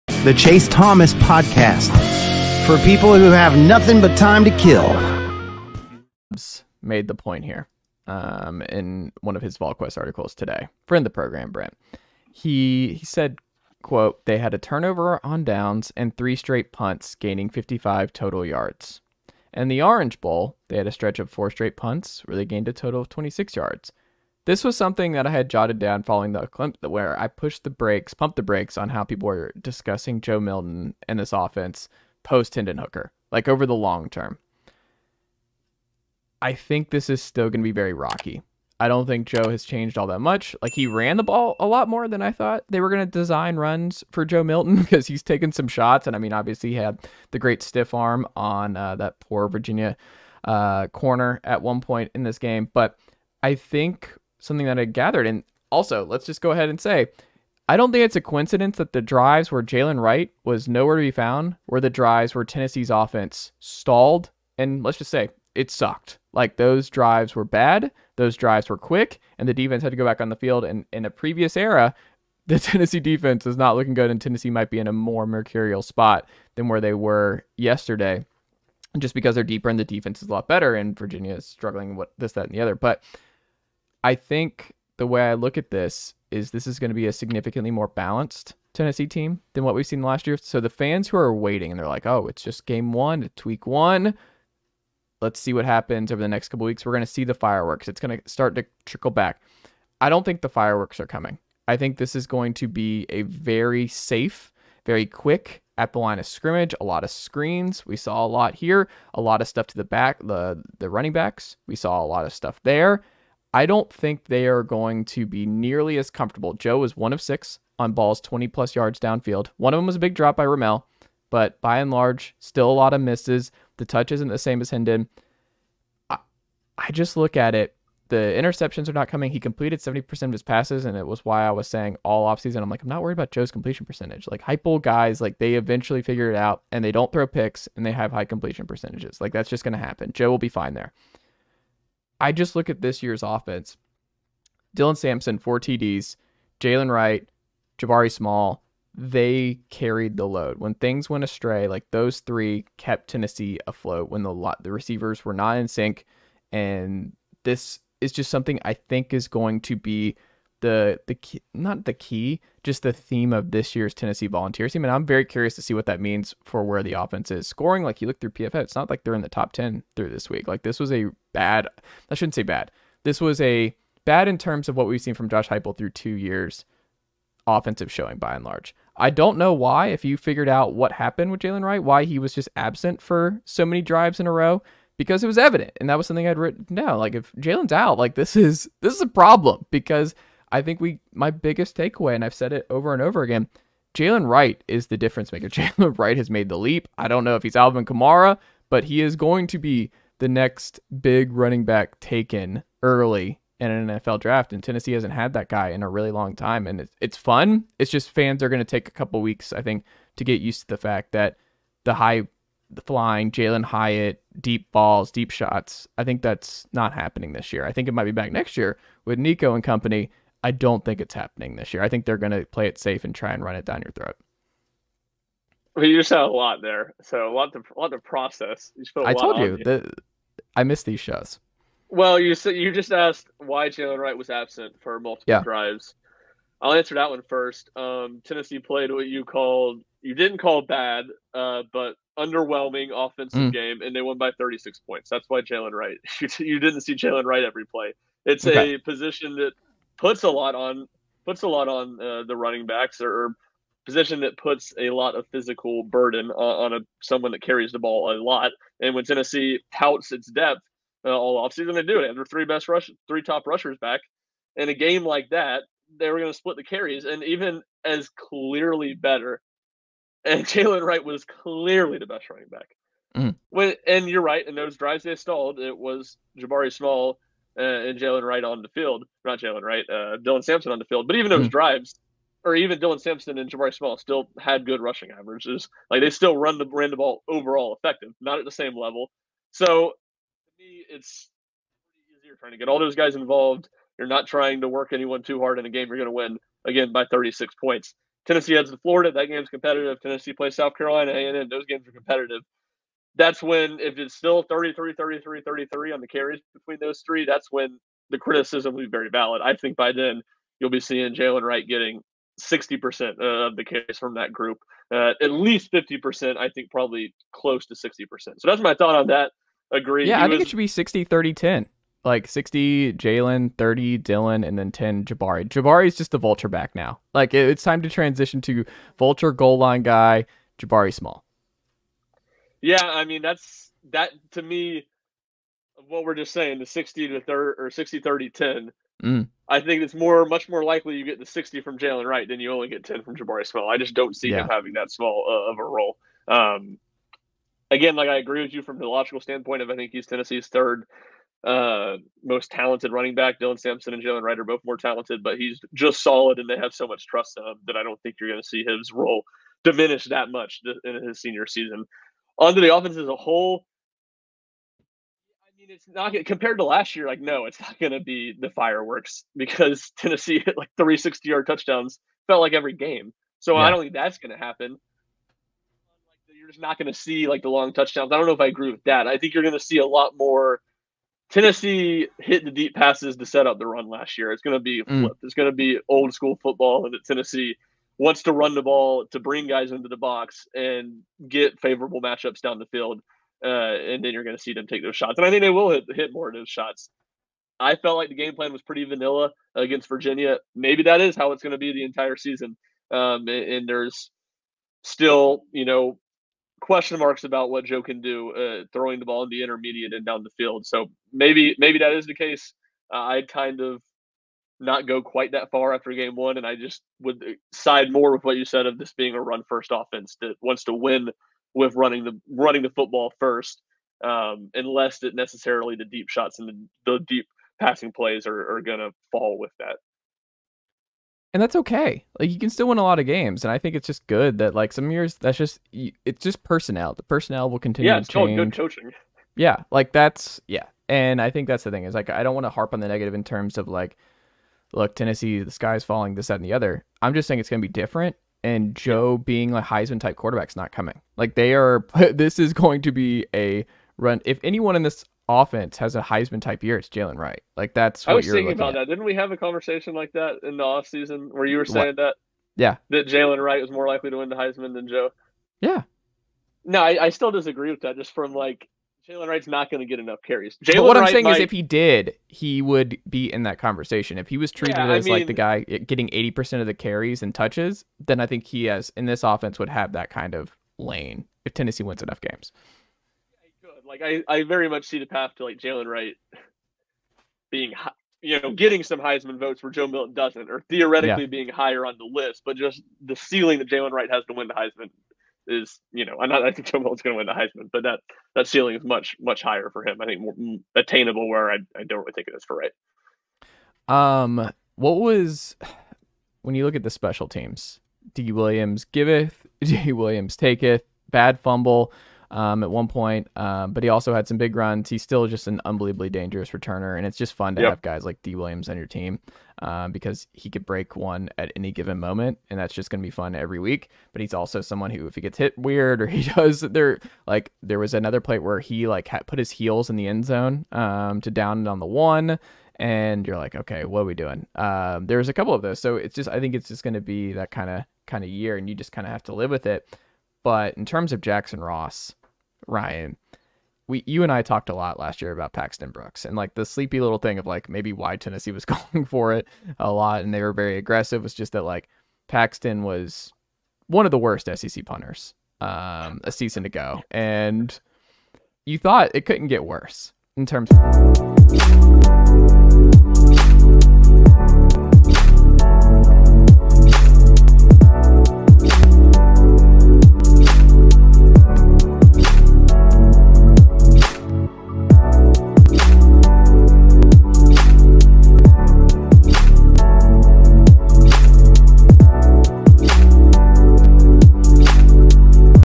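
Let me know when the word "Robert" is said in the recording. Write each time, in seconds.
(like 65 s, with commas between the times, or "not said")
not said.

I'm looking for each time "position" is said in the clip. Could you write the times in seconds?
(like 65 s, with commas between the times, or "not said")
248 s, 253 s.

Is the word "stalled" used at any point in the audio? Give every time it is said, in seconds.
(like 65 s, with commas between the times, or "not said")
63 s, 275 s.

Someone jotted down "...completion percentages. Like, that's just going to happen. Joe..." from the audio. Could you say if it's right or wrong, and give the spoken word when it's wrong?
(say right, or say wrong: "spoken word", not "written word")
right.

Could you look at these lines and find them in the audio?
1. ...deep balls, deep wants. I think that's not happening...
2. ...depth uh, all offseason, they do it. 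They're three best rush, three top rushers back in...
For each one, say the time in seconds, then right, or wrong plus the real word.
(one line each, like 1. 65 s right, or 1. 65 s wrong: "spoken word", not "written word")
1. 214 s wrong: "shots", not "wants"
2. 260 s right.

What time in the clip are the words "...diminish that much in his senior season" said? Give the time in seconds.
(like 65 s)
359 s.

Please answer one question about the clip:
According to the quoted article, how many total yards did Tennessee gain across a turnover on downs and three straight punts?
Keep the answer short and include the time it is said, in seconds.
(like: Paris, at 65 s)
55, at 17 s.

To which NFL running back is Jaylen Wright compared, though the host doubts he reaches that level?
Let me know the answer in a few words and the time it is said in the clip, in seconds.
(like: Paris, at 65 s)
Alvin Kamara, at 197 s.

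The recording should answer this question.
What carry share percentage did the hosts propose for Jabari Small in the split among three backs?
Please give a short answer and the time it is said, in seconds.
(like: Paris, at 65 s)
10, at 324 s.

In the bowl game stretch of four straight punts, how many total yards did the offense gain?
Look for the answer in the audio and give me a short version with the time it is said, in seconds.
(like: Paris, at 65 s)
26, at 23 s.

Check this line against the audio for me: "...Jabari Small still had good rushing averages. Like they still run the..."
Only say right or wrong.
right.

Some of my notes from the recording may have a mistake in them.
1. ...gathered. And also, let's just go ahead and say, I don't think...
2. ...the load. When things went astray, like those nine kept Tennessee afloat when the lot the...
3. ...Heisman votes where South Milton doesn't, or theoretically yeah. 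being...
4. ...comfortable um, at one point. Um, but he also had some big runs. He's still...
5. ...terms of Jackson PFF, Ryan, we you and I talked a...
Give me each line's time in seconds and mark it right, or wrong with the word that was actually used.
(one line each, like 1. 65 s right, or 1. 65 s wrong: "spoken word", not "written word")
1. 54 s right
2. 150 s wrong: "three", not "nine"
3. 489 s wrong: "Joe", not "South"
4. 511 s wrong: "fumble", not "comfortable"
5. 540 s wrong: "Ross", not "PFF".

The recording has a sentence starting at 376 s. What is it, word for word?
You're just not going to see like the long touchdowns.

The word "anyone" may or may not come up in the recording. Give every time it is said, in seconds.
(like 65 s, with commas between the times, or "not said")
294 s, 454 s.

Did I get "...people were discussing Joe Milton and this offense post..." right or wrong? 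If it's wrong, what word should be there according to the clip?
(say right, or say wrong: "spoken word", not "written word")
right.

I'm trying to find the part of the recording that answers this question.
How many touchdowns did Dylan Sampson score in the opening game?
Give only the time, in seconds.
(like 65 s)
145 s.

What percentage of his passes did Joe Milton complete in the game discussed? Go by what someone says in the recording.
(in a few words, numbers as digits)
70%.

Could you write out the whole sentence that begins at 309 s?
I think by then you'll be seeing Jaylen Wright getting 60% uh, of the case from that group.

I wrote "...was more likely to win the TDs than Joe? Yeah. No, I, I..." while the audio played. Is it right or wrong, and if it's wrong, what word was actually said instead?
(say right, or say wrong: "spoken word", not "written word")
wrong: "Heisman", not "TDs".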